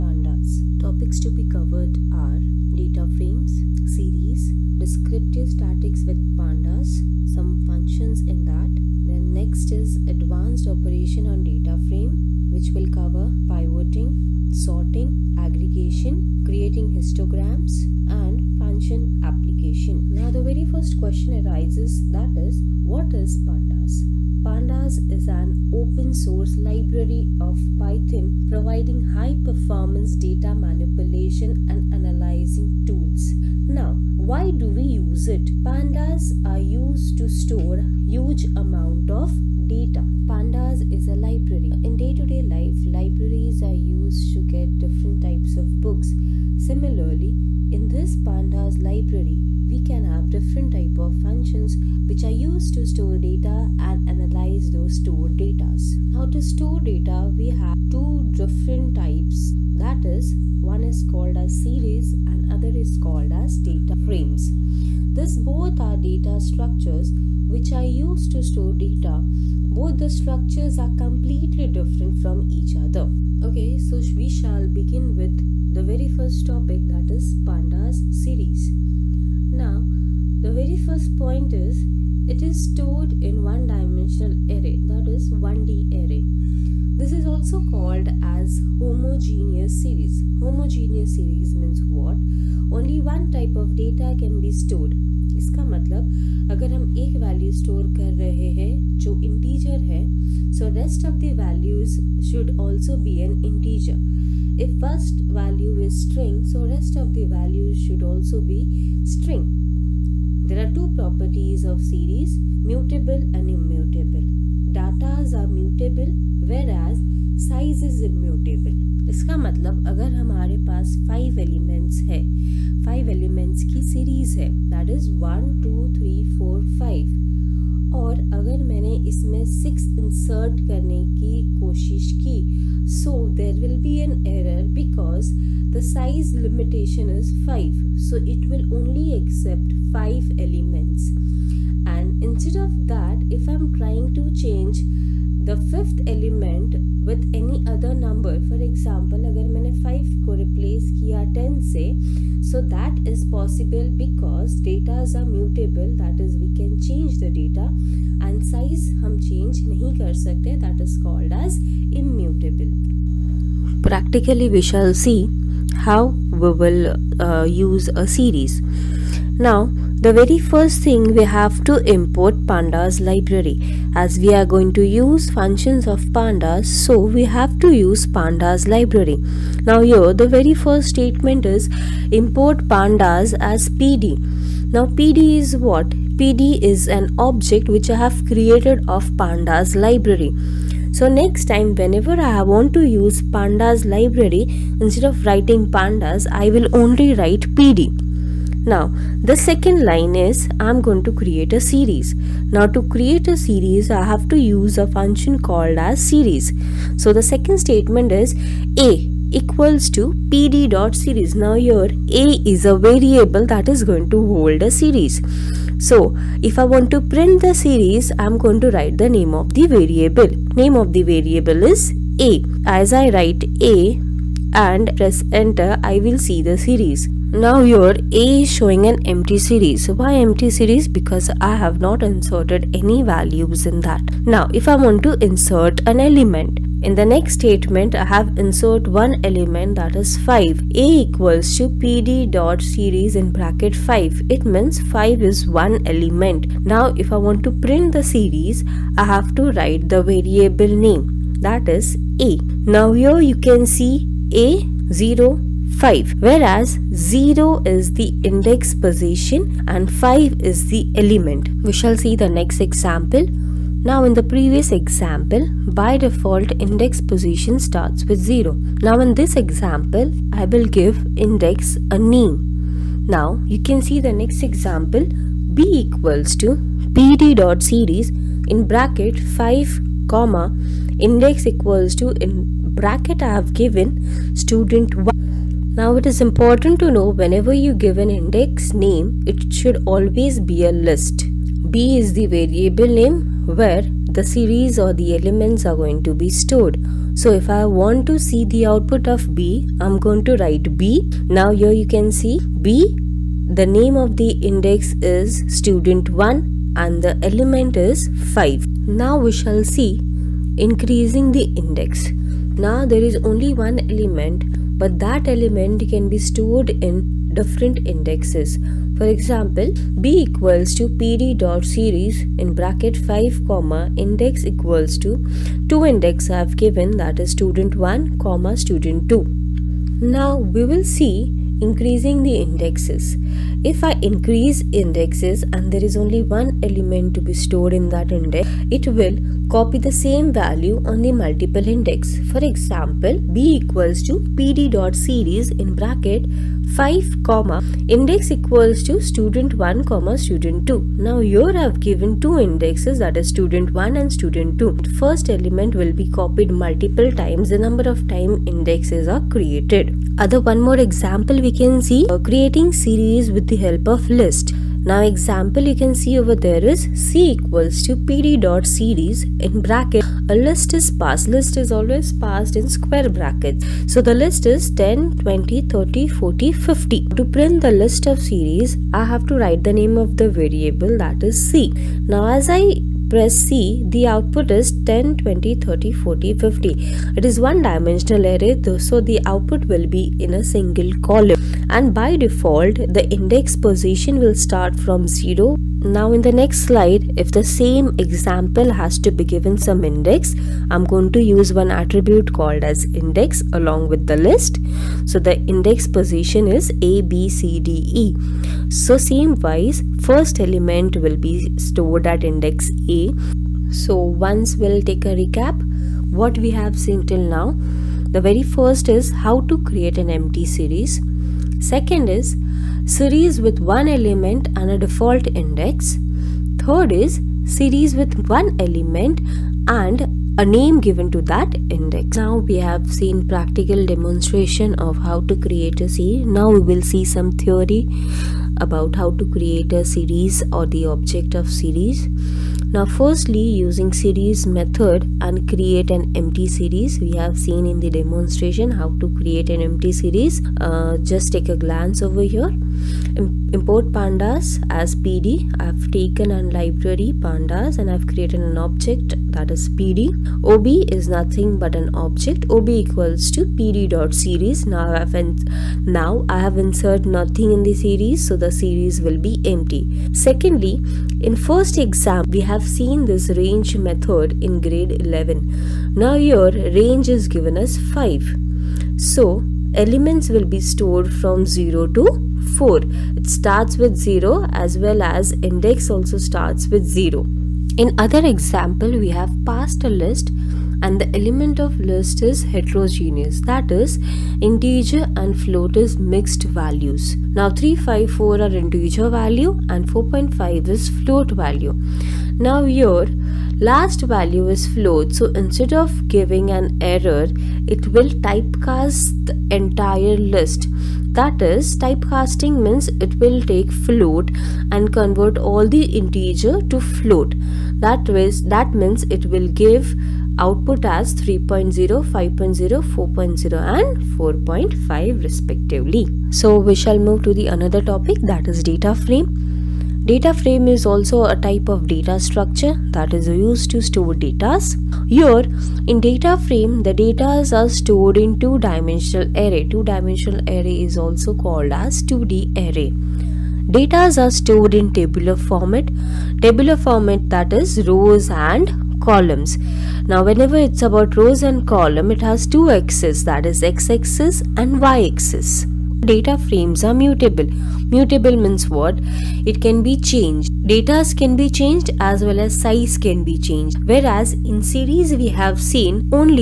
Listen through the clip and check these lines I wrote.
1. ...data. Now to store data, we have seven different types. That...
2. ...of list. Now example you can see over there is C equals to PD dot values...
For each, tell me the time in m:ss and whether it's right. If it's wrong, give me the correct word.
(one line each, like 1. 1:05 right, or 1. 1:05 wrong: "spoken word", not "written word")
1. 0:55 wrong: "two", not "seven"
2. 6:03 wrong: "series", not "values".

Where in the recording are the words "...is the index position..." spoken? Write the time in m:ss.
4:17.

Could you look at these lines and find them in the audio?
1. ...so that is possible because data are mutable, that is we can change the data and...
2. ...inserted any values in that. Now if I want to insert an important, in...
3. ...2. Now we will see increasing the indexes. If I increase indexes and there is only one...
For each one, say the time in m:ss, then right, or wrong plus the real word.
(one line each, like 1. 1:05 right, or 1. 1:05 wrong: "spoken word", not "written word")
1. 2:32 right
2. 3:52 wrong: "element", not "important"
3. 5:29 right.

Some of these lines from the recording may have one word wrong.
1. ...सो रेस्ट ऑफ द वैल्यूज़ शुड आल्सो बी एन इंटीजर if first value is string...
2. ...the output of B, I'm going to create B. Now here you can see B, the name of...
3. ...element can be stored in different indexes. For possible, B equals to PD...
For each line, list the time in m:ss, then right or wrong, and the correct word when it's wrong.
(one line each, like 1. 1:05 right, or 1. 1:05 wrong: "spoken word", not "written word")
1. 1:40 right
2. 4:58 wrong: "write", not "create"
3. 5:15 wrong: "example", not "possible".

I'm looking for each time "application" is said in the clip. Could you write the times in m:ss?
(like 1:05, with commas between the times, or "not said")
0:19.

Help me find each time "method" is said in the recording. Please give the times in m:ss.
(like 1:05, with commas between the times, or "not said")
7:24, 7:53.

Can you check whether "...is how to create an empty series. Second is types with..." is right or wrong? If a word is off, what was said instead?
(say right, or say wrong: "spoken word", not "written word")
wrong: "series", not "types".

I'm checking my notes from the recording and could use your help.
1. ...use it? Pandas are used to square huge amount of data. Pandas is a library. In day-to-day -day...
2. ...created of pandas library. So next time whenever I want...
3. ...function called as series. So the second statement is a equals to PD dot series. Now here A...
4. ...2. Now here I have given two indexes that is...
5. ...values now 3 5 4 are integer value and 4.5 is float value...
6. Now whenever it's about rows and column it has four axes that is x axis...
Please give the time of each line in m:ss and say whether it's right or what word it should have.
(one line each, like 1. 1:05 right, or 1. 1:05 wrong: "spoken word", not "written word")
1. 0:34 wrong: "store", not "square"
2. 3:08 right
3. 3:24 right
4. 5:50 right
5. 8:16 right
6. 9:10 wrong: "two", not "four".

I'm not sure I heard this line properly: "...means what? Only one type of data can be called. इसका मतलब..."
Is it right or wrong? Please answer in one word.
wrong.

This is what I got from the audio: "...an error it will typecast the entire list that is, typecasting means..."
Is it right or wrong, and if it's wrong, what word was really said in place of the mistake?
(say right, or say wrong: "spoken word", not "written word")
right.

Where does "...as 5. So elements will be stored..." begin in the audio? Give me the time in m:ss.
7:57.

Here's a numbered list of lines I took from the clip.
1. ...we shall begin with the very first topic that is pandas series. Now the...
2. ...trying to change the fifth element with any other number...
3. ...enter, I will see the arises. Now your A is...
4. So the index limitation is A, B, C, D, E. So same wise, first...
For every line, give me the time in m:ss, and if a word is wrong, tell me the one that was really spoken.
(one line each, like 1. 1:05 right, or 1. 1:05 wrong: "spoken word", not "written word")
1. 1:14 right
2. 2:23 right
3. 3:45 wrong: "series", not "arises"
4. 6:45 wrong: "position", not "limitation".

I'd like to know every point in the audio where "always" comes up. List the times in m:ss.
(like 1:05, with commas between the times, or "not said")
4:49, 6:11.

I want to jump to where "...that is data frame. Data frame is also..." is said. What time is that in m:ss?
8:48.